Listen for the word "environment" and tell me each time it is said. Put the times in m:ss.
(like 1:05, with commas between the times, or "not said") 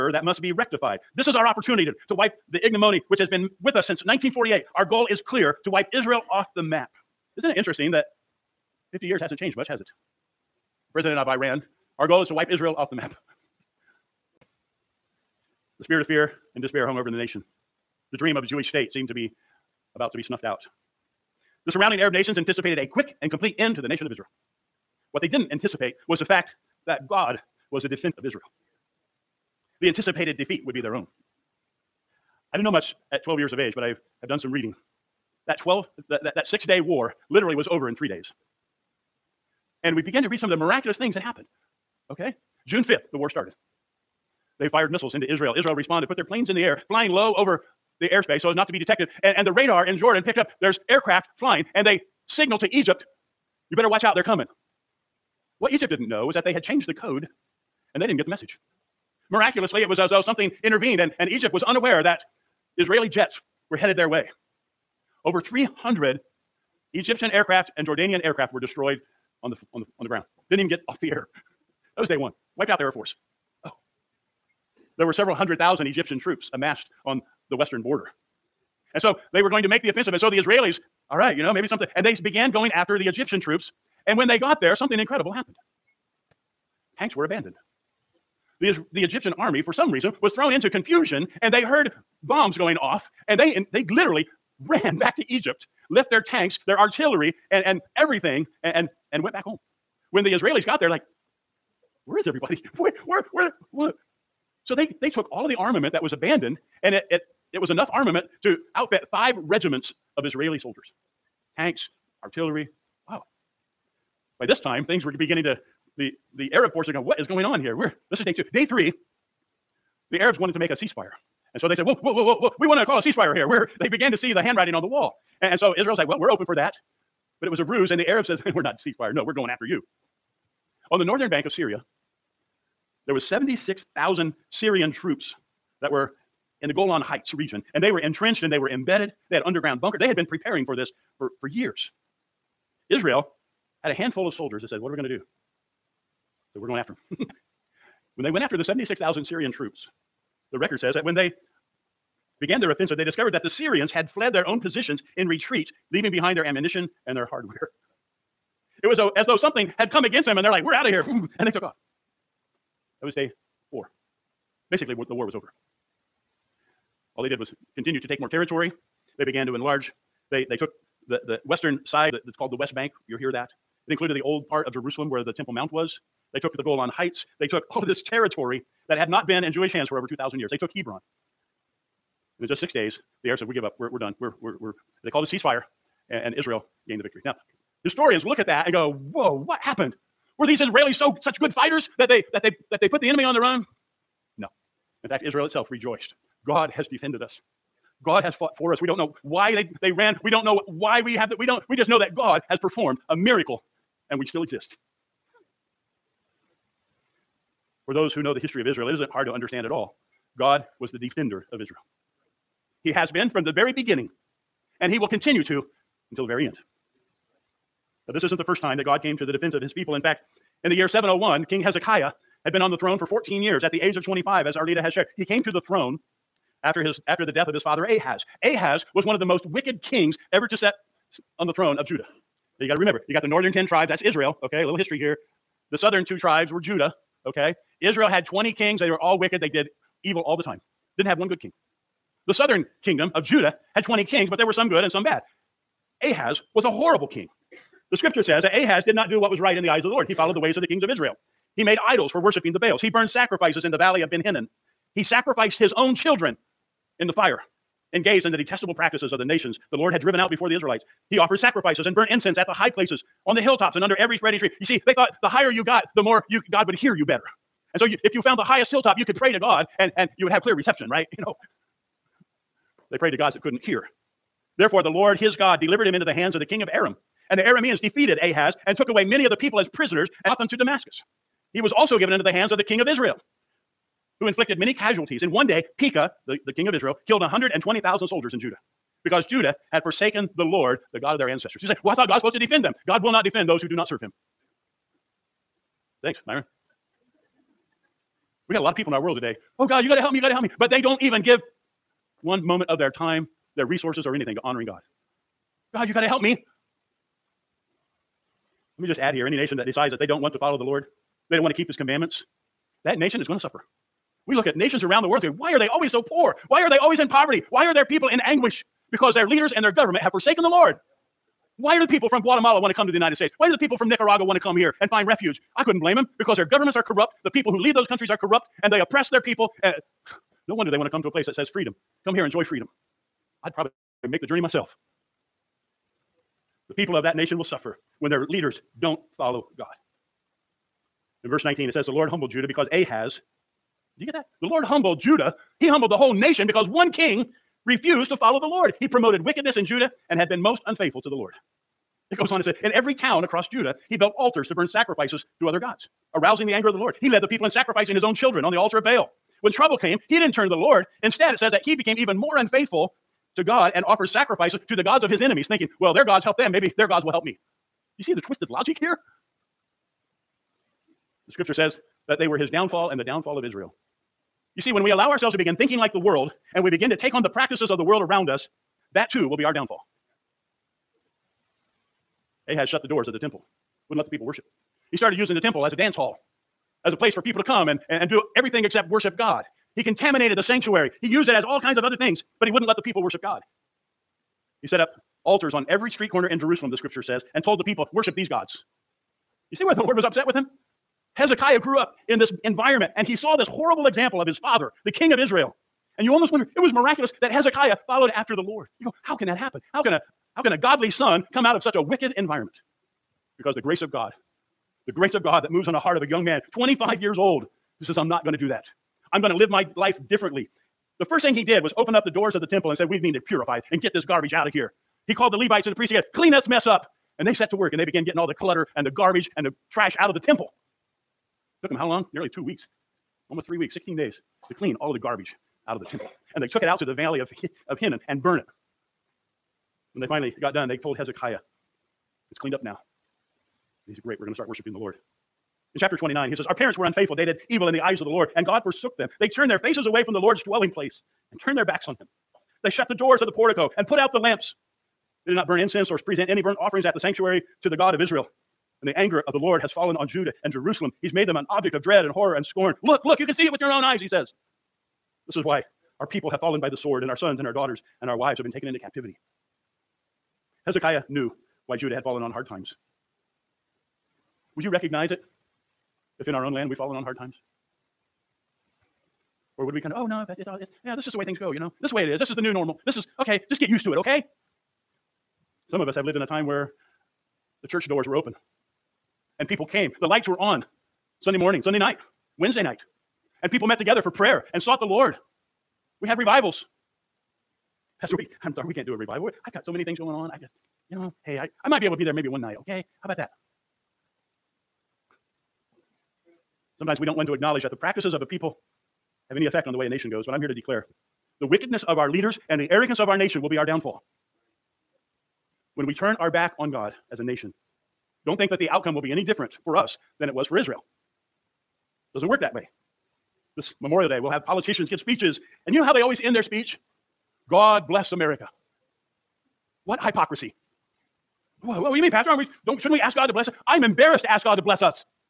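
6:42, 6:52.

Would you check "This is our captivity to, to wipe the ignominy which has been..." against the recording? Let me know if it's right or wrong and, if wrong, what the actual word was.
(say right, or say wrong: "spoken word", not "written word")
wrong: "opportunity", not "captivity".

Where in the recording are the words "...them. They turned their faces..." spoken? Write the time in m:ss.
7:28.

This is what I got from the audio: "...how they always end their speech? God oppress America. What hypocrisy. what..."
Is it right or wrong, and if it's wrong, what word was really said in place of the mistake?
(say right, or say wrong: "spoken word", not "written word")
wrong: "bless", not "oppress".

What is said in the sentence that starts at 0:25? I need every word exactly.
What they didn't anticipate was the fact that God was the defender of Israel.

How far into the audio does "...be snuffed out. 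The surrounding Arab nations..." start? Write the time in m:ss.
0:20.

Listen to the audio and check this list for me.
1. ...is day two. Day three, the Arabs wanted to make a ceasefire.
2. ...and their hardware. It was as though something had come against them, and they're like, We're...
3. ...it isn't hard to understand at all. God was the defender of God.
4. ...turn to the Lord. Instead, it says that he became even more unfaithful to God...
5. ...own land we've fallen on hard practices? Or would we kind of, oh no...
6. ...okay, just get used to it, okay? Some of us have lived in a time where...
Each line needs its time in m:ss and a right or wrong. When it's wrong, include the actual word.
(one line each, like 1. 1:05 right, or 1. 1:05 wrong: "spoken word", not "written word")
1. 1:58 right
2. 2:37 right
3. 3:28 wrong: "Israel", not "God"
4. 6:00 right
5. 7:56 wrong: "times", not "practices"
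6. 8:03 right.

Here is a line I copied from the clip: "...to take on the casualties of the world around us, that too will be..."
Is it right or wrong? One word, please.
wrong.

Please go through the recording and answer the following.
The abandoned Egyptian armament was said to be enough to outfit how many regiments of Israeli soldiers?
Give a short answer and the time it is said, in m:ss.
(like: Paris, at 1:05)
5, at 1:49.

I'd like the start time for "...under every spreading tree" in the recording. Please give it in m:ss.
4:23.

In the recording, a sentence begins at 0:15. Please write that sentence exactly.
The spirit of fear and despair hung over the nation.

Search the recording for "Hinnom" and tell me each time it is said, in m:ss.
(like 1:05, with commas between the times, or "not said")
4:14, 7:17.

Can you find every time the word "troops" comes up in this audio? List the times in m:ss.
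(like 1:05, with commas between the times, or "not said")
1:16, 1:23, 2:14, 2:29.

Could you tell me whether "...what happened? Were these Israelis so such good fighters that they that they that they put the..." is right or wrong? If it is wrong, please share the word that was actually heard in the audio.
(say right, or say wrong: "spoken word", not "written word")
right.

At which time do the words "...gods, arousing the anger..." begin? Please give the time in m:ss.
5:55.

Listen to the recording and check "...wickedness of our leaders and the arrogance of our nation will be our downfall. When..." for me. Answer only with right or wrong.
right.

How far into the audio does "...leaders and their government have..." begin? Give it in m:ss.
5:19.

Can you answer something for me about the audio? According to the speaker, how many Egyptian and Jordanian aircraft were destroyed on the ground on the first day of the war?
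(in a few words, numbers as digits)
Over 300.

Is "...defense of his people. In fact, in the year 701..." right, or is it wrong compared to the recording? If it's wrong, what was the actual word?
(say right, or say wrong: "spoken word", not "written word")
right.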